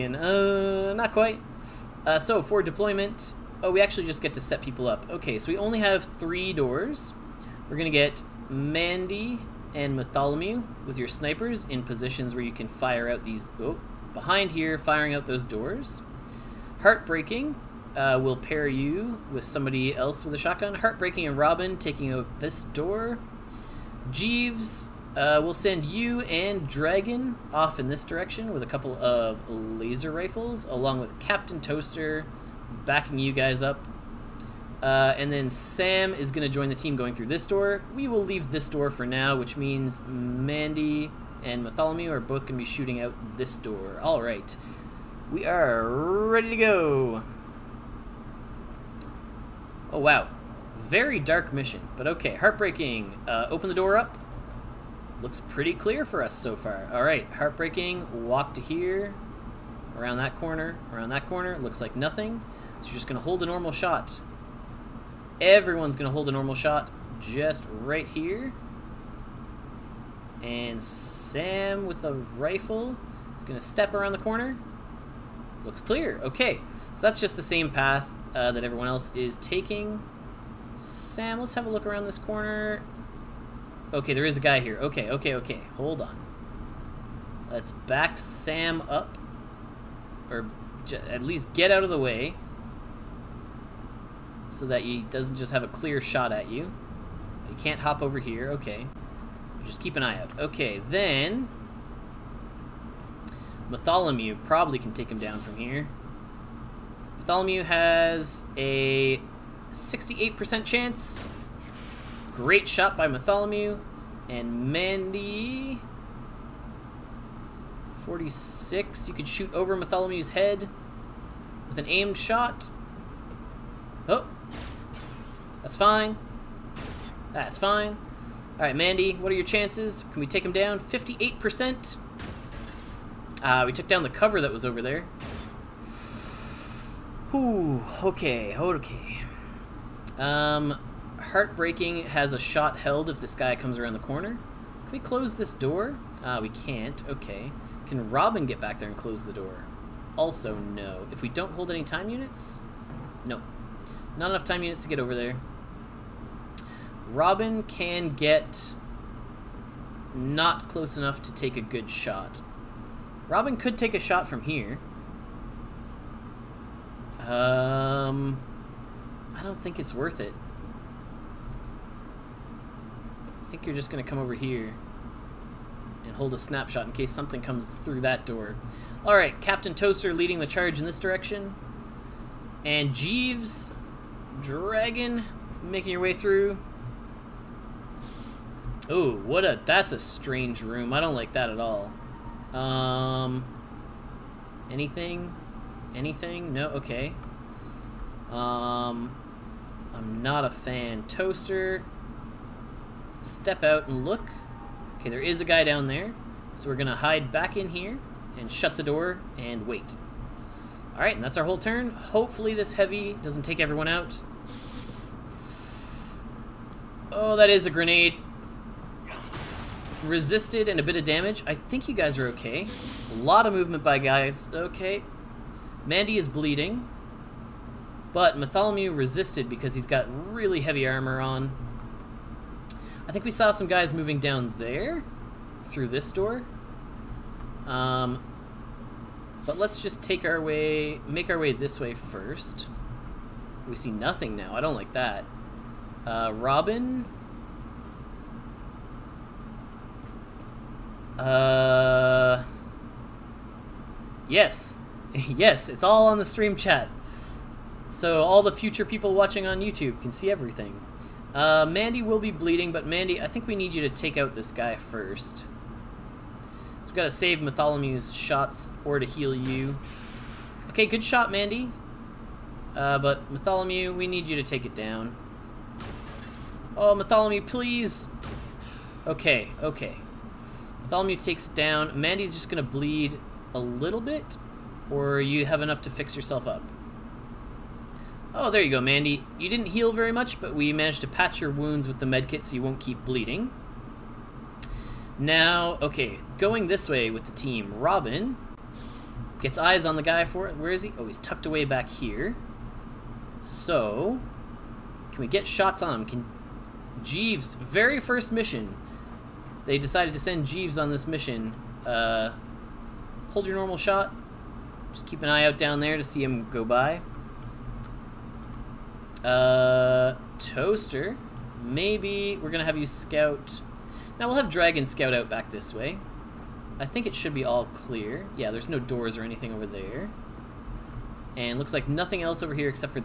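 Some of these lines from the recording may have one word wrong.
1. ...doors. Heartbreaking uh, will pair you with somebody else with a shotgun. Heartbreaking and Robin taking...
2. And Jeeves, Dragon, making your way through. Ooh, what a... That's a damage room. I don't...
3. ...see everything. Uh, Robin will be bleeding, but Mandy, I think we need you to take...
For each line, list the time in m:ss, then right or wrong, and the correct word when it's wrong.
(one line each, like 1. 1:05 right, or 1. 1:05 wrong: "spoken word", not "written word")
1. 0:15 right
2. 3:02 wrong: "strange", not "damage"
3. 4:20 wrong: "Mandy", not "Robin".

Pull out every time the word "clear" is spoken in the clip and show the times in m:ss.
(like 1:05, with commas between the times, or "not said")
0:55, 1:15, 1:35, 5:27.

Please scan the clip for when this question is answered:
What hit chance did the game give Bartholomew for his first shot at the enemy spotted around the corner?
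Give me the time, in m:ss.
1:49.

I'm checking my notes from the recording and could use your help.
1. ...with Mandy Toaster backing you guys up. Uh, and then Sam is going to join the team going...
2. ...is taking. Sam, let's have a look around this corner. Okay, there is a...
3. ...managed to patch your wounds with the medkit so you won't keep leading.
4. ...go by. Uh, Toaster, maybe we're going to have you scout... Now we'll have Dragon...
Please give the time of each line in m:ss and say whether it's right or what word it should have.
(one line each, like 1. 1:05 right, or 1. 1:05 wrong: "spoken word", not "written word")
1. 0:30 wrong: "Captain", not "Mandy"
2. 1:19 right
3. 4:50 wrong: "bleeding", not "leading"
4. 5:16 right.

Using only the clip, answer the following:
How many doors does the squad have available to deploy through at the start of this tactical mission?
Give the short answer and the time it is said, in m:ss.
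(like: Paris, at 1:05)
3, at 0:06.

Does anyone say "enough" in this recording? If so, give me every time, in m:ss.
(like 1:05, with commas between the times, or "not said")
2:34, 2:40, 4:45.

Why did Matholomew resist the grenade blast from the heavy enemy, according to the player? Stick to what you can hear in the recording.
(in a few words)
really heavy armor.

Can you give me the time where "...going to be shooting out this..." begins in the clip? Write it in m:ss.
0:42.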